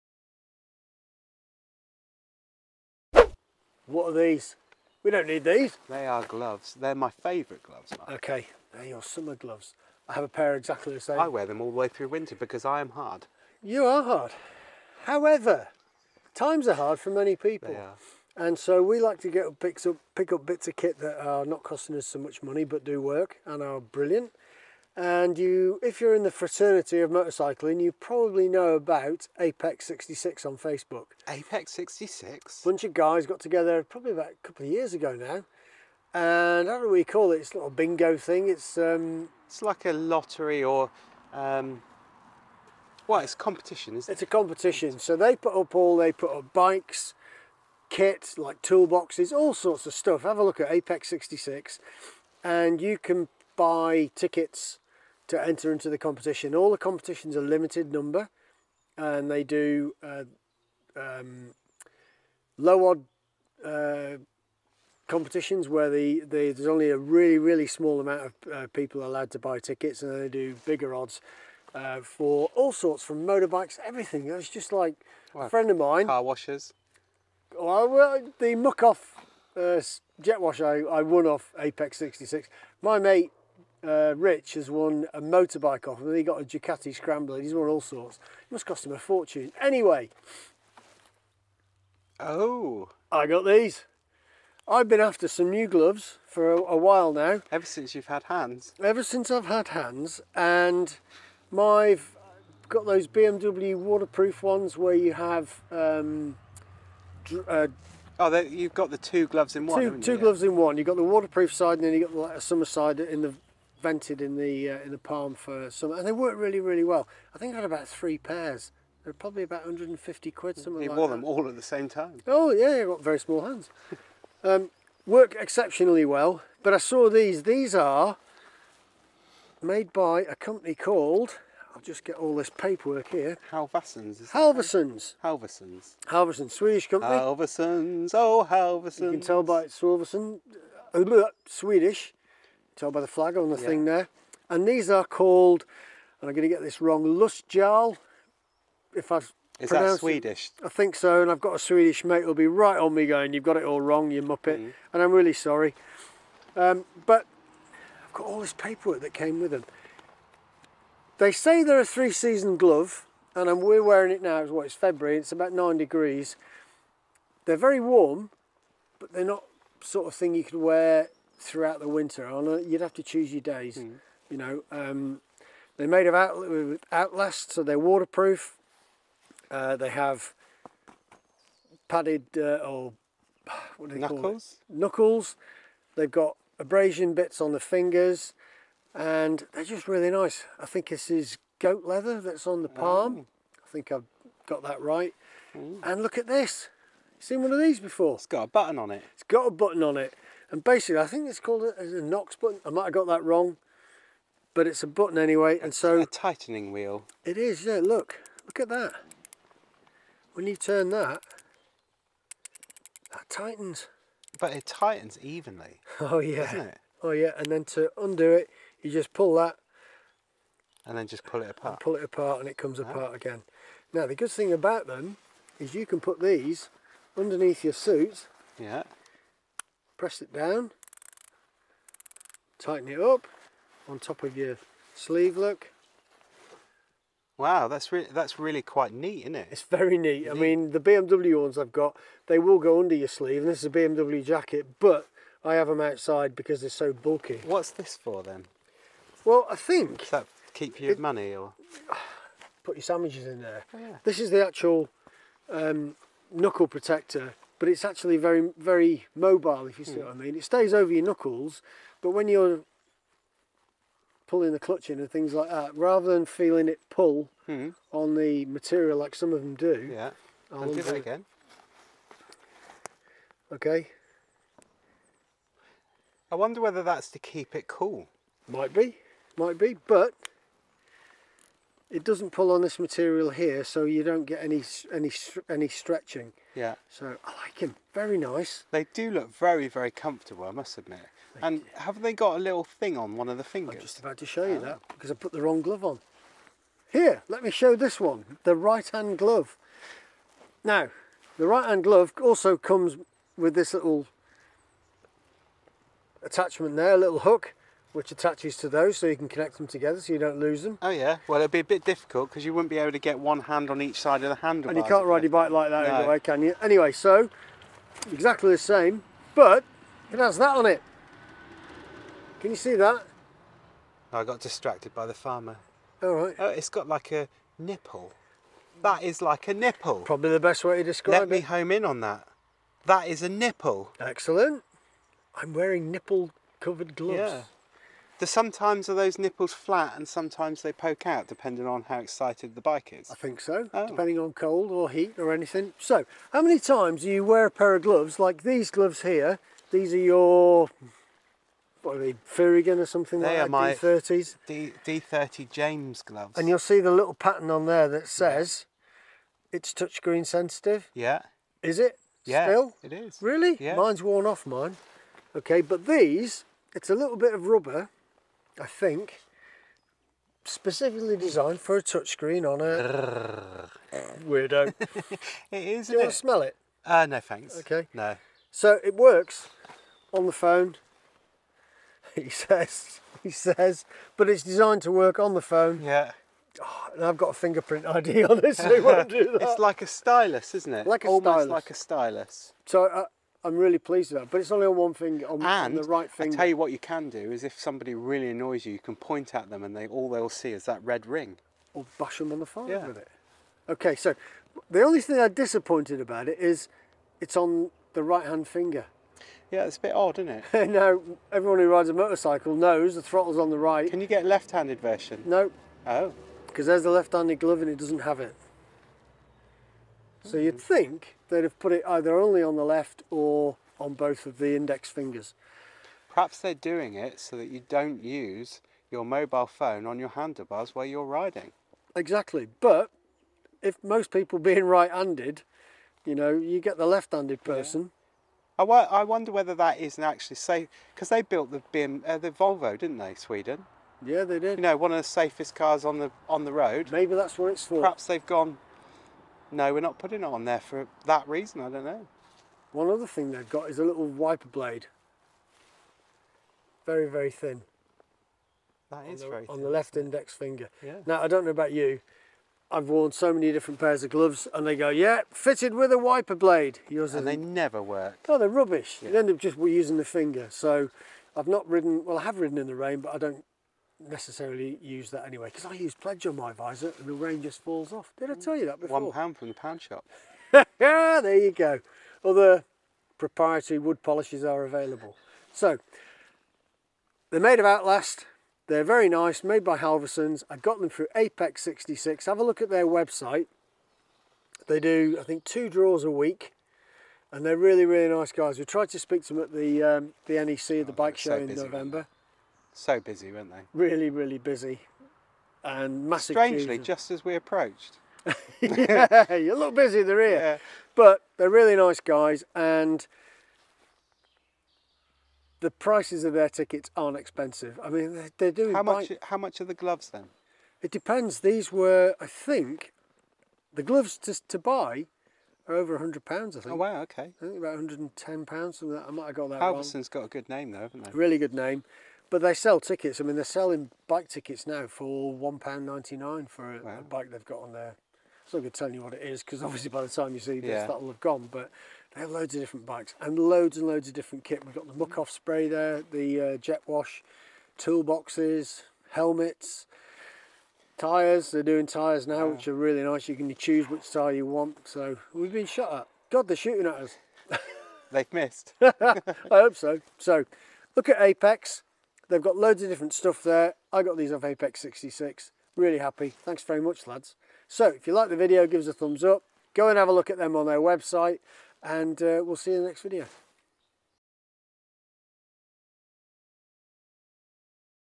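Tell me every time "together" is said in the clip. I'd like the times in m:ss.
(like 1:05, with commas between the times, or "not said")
0:33, 5:09.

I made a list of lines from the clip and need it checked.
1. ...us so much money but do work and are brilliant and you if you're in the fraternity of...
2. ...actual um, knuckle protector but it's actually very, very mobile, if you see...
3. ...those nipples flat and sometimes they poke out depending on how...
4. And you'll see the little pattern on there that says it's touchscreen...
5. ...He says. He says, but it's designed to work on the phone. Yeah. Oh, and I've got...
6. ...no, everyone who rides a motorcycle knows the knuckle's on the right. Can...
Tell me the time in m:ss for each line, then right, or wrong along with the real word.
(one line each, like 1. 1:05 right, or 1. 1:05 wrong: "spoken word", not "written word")
1. 0:21 right
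2. 4:14 right
3. 5:38 right
4. 5:56 right
5. 6:22 right
6. 6:50 wrong: "throttle", not "knuckle".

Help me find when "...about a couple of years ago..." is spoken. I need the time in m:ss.
0:34.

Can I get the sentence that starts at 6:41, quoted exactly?
Or bash them on the forehead yeah.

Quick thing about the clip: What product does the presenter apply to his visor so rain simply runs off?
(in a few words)
Pledge.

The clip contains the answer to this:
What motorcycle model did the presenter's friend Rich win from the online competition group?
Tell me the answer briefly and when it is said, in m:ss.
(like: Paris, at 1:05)
Ducati Scrambler, at 1:26.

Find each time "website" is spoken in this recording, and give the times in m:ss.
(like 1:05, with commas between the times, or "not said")
8:12, 9:30.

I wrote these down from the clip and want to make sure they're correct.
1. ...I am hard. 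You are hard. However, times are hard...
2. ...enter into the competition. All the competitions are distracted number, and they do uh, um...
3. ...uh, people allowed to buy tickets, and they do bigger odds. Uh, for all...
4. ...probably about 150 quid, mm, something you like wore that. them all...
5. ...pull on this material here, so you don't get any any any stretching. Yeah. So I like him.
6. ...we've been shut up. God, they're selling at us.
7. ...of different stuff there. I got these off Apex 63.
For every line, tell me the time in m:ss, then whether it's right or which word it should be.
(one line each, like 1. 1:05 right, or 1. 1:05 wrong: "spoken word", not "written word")
1. 0:12 right
2. 0:55 wrong: "limited", not "distracted"
3. 1:08 right
4. 1:59 right
5. 4:42 right
6. 9:15 wrong: "shooting", not "selling"
7. 9:22 wrong: "66", not "63".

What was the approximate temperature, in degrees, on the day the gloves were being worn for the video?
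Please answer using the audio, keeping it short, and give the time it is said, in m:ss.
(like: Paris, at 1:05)
9 degrees, at 2:45.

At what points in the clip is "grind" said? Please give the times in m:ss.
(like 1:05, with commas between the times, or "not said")
not said.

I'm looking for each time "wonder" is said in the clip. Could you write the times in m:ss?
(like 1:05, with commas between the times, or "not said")
4:36, 7:19.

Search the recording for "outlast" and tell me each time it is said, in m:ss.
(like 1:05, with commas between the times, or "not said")
2:56, 8:07.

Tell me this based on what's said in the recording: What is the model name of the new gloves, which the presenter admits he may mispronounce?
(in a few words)
Lustjarl.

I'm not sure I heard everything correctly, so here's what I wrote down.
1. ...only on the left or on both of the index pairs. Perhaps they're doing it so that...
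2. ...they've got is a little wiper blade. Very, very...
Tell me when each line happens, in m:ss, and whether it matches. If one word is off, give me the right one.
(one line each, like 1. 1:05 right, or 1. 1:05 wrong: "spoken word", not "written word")
1. 7:02 wrong: "fingers", not "pairs"
2. 7:33 right.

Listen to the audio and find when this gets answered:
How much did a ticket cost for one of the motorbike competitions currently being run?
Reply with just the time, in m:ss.
8:55.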